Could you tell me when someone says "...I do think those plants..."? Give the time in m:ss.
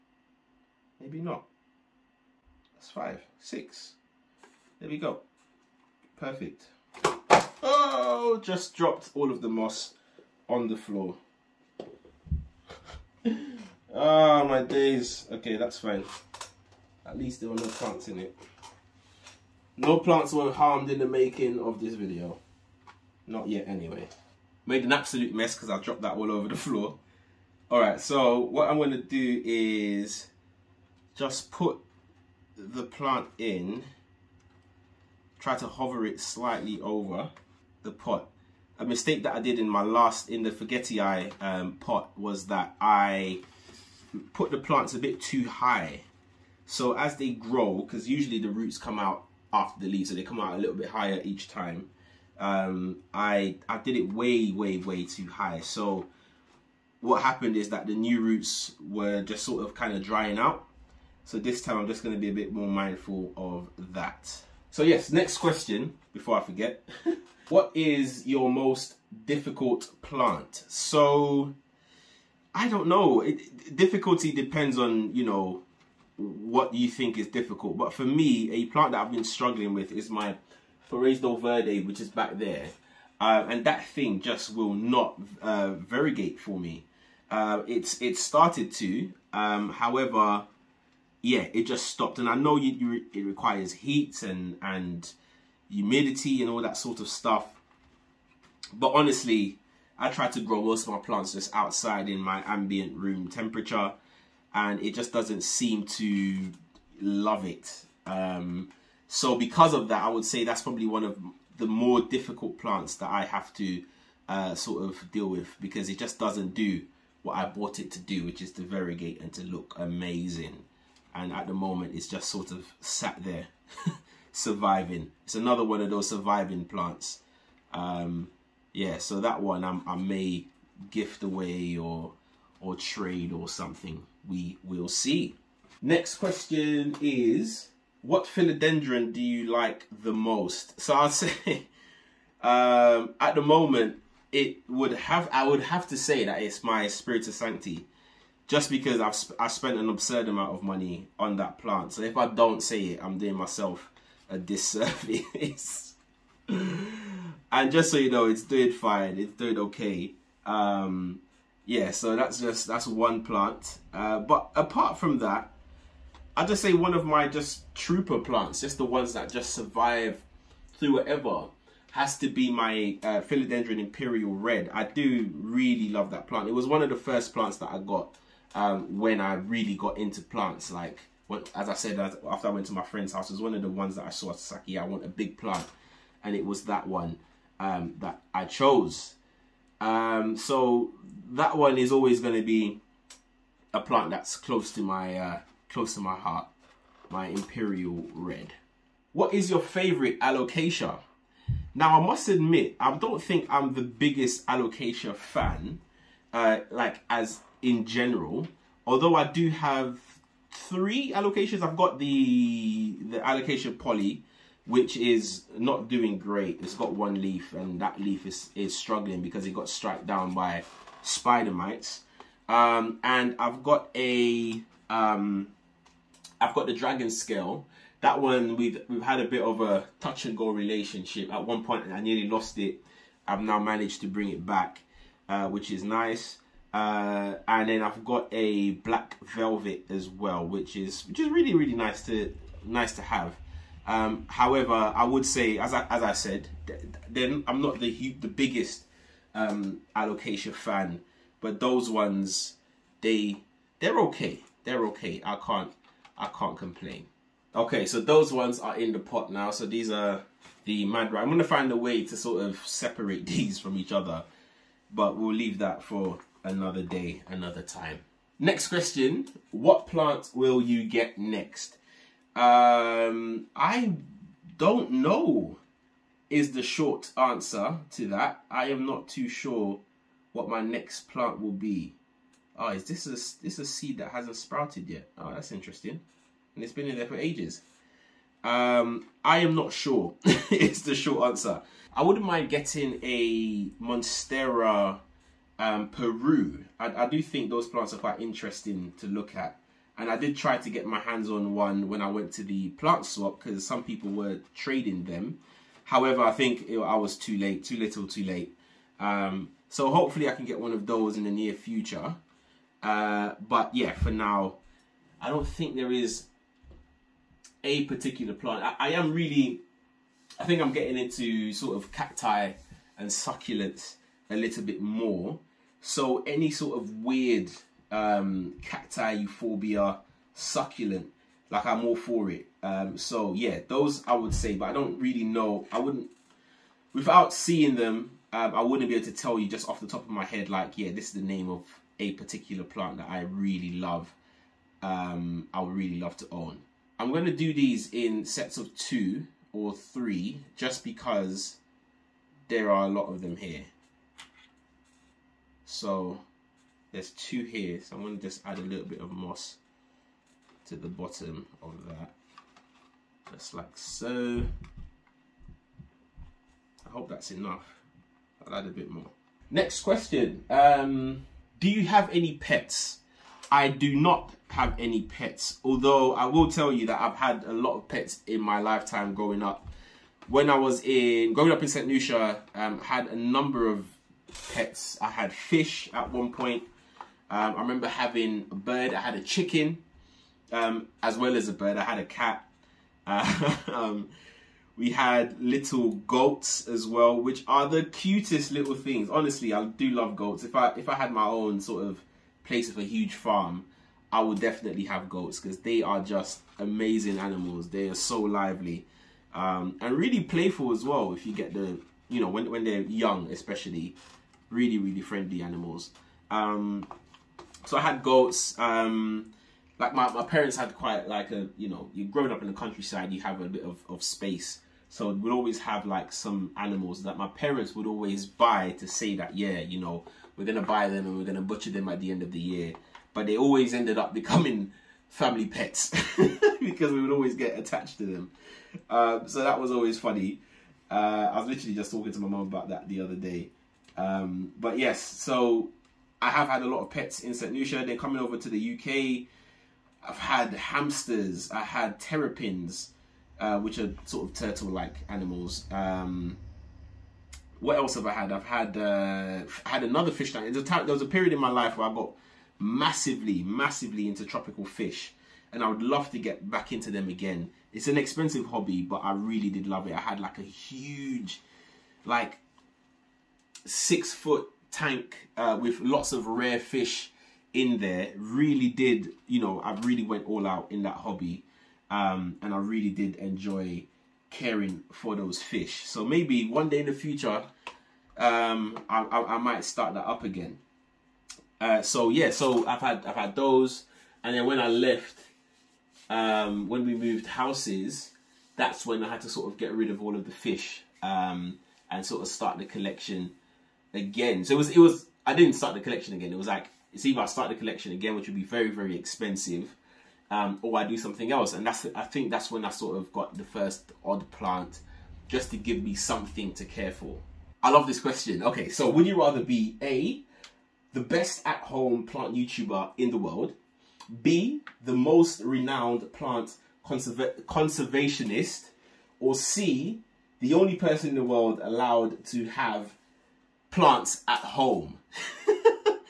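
4:57.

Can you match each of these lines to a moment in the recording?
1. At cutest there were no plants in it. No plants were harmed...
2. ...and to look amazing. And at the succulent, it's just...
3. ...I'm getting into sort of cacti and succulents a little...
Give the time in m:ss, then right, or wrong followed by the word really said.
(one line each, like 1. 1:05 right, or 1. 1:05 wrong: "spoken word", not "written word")
1. 0:17 wrong: "least", not "cutest"
2. 1:59 wrong: "moment", not "succulent"
3. 5:20 right.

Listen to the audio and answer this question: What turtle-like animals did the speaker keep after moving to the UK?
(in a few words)
Terrapins.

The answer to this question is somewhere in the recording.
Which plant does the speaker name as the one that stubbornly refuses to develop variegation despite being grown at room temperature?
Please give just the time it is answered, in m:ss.
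1:20.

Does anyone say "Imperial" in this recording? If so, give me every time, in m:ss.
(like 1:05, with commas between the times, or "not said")
2:53, 3:17.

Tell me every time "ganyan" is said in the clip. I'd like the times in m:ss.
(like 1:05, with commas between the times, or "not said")
not said.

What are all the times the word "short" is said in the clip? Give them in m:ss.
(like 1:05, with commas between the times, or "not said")
4:36, 4:50.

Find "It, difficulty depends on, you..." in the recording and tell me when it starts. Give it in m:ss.
1:13.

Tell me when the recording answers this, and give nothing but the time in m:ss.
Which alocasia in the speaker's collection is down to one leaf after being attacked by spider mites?
3:33.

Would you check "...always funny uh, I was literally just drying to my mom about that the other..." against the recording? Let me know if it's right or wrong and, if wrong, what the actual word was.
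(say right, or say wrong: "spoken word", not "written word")
wrong: "talking", not "drying".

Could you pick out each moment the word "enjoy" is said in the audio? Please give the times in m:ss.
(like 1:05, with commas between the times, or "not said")
8:03.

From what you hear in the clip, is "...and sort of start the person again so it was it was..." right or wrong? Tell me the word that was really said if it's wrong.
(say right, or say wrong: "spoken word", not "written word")
wrong: "collection", not "person".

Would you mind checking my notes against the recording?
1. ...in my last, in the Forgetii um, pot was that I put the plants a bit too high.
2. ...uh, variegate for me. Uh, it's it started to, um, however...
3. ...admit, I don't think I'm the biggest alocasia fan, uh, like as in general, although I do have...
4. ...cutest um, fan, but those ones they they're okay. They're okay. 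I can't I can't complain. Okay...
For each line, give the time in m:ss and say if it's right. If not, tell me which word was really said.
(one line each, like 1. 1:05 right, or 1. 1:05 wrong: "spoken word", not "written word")
1. 0:39 right
2. 1:25 right
3. 3:22 right
4. 4:08 wrong: "biggest", not "cutest".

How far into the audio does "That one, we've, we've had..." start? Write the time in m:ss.
3:47.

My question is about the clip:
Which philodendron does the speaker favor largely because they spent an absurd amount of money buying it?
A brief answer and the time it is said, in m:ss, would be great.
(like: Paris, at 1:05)
Spiritus sancti, at 2:26.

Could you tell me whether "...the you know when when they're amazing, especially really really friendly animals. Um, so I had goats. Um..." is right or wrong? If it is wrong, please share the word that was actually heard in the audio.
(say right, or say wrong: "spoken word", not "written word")
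wrong: "young", not "amazing".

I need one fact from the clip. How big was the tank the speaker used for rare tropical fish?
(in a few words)
6 foot.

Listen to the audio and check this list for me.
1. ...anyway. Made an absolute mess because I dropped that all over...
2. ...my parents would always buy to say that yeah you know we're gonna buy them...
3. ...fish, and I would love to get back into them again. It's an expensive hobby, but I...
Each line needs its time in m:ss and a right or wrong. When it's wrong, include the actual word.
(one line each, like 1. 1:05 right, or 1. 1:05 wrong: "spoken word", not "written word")
1. 0:23 right
2. 7:07 right
3. 7:44 right.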